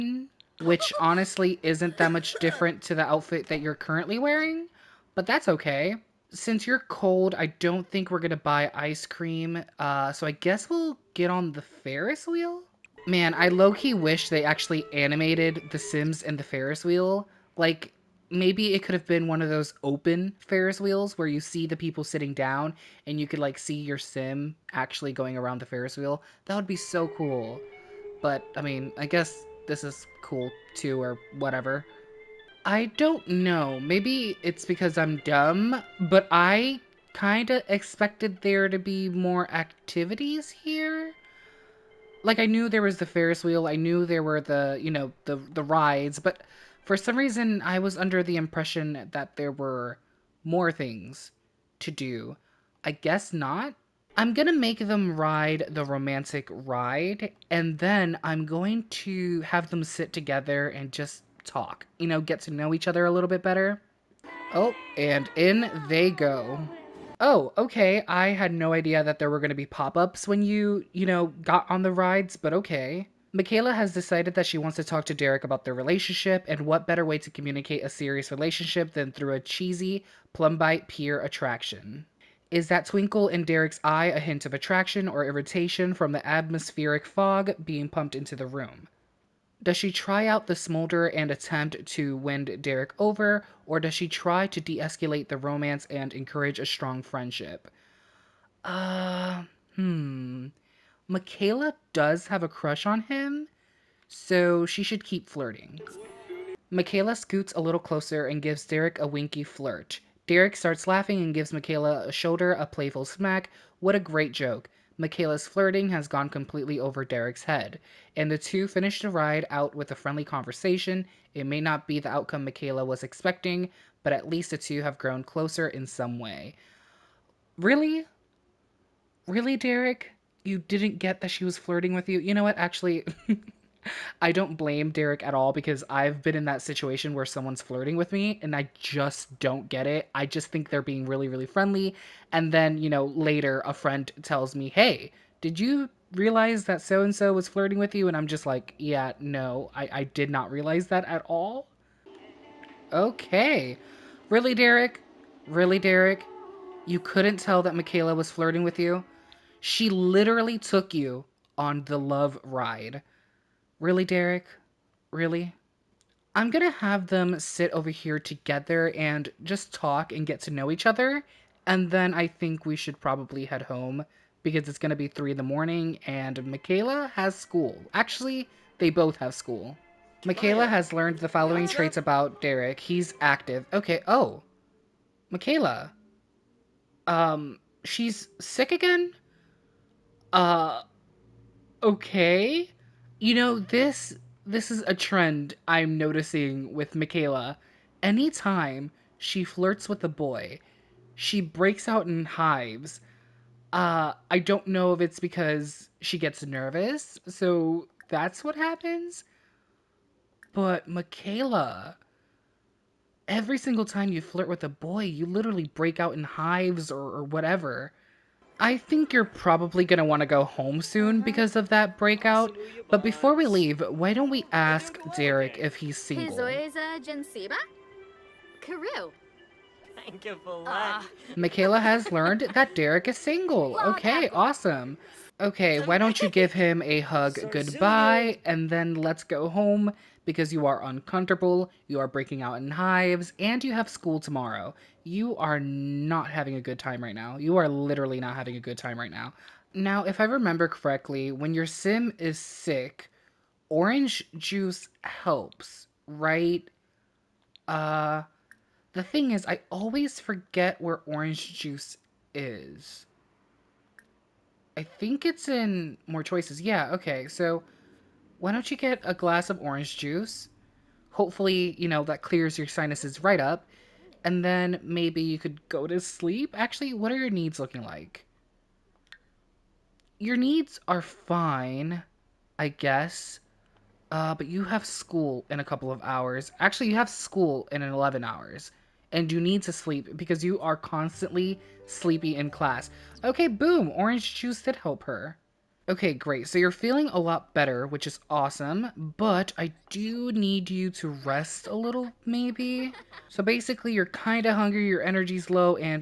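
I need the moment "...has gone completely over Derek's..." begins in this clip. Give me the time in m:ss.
1:55.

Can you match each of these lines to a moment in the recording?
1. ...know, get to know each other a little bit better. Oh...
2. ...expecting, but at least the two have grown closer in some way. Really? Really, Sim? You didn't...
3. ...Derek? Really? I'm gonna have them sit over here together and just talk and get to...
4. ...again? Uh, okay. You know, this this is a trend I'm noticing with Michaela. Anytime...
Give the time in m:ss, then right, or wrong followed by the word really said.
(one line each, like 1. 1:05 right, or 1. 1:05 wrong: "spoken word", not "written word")
1. 1:02 right
2. 2:03 wrong: "Derek", not "Sim"
3. 2:44 right
4. 3:08 right.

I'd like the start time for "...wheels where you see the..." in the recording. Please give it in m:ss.
0:20.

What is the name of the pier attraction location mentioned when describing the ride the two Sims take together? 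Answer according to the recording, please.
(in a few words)
Plumbite Pier.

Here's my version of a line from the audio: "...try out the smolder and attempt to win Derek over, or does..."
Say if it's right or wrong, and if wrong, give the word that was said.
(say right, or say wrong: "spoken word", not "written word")
right.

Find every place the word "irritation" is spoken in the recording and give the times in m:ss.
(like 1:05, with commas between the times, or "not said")
1:25.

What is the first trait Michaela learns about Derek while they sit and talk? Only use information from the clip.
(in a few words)
active.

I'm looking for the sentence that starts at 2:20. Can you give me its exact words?
I just think they're being really, really friendly.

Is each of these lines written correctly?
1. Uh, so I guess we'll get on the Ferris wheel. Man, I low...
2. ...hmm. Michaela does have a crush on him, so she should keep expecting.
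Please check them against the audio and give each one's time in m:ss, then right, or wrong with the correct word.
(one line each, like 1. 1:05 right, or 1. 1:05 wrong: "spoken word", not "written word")
1. 0:09 right
2. 1:39 wrong: "flirting", not "expecting".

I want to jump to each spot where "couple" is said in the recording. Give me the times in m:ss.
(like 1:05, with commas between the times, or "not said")
4:45.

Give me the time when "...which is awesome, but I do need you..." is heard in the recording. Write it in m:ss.
4:57.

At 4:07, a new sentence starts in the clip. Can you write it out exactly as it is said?
You are literally not having a good time right now.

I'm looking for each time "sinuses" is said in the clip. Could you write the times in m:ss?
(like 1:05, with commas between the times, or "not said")
4:32.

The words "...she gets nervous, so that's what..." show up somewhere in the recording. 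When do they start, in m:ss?
3:25.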